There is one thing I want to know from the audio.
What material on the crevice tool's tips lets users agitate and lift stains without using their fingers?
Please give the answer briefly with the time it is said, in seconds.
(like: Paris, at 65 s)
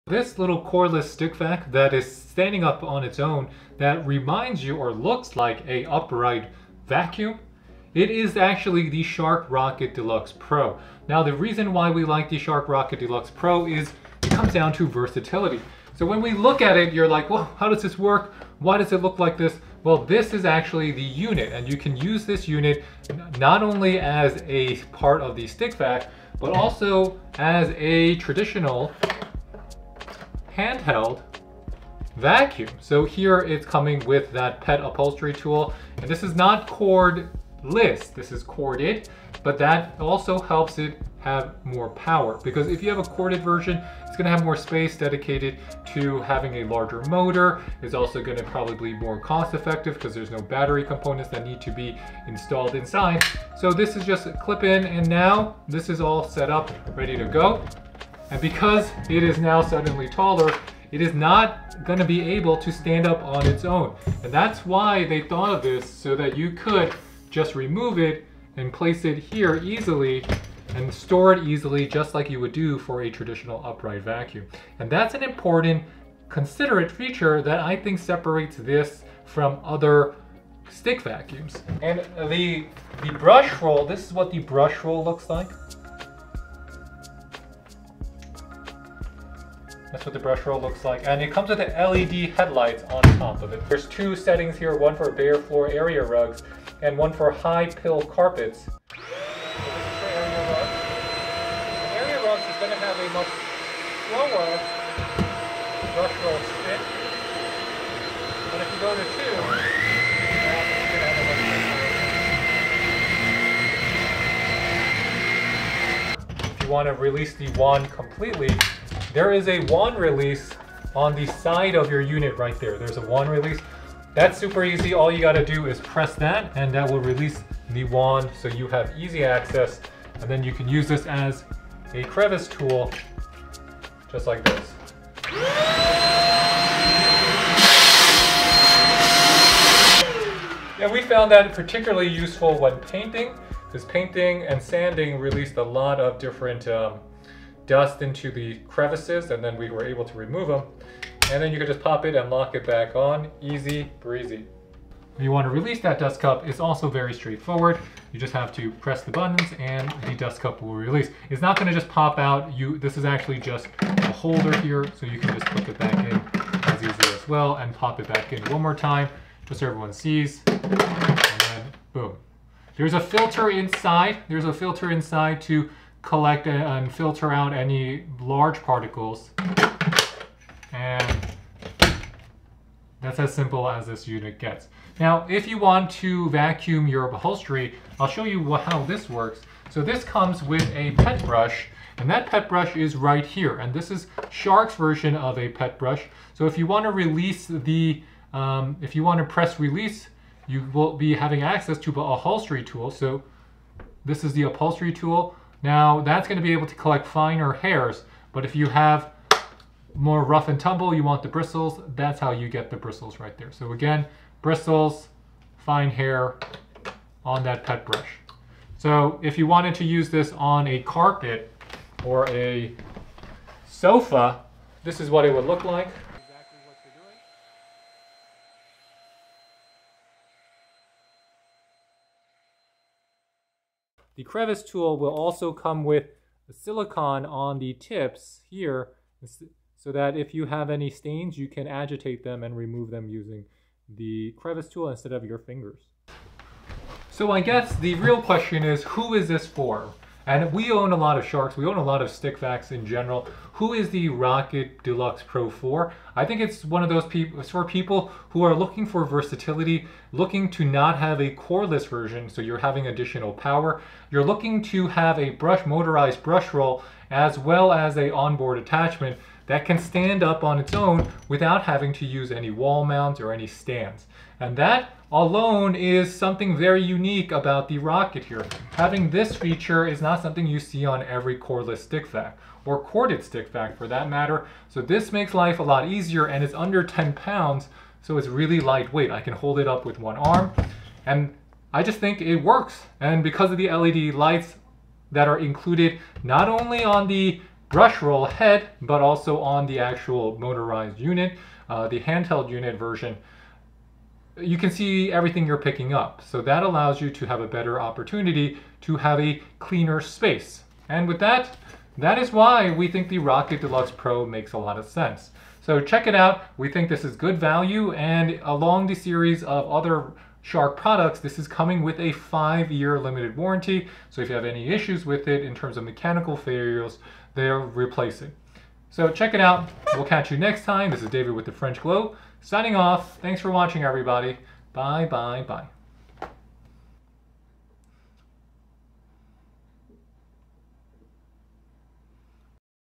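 silicone, at 236 s.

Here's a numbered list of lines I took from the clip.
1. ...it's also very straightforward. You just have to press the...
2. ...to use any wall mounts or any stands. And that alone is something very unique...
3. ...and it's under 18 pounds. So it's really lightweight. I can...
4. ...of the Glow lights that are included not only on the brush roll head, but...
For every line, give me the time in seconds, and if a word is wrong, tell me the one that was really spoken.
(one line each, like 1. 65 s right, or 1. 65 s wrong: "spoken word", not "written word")
1. 156 s right
2. 271 s right
3. 286 s wrong: "10", not "18"
4. 293 s wrong: "LED", not "Glow".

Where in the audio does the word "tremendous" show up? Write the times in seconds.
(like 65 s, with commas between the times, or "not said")
not said.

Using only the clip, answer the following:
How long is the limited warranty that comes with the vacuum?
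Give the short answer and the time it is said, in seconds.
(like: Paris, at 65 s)
5 years, at 322 s.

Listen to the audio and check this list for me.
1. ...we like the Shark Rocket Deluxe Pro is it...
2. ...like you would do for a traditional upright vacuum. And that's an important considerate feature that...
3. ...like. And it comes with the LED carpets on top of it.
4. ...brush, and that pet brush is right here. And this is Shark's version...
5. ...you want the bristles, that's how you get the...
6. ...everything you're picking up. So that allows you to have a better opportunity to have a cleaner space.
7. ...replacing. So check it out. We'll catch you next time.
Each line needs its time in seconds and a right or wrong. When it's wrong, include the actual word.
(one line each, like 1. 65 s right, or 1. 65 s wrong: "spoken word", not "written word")
1. 11 s right
2. 72 s right
3. 90 s wrong: "headlights", not "carpets"
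4. 191 s right
5. 210 s right
6. 305 s right
7. 327 s right.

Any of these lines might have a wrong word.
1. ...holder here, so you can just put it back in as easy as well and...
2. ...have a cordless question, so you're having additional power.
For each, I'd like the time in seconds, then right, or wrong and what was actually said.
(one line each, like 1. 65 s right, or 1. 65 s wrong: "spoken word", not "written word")
1. 164 s right
2. 260 s wrong: "version", not "question".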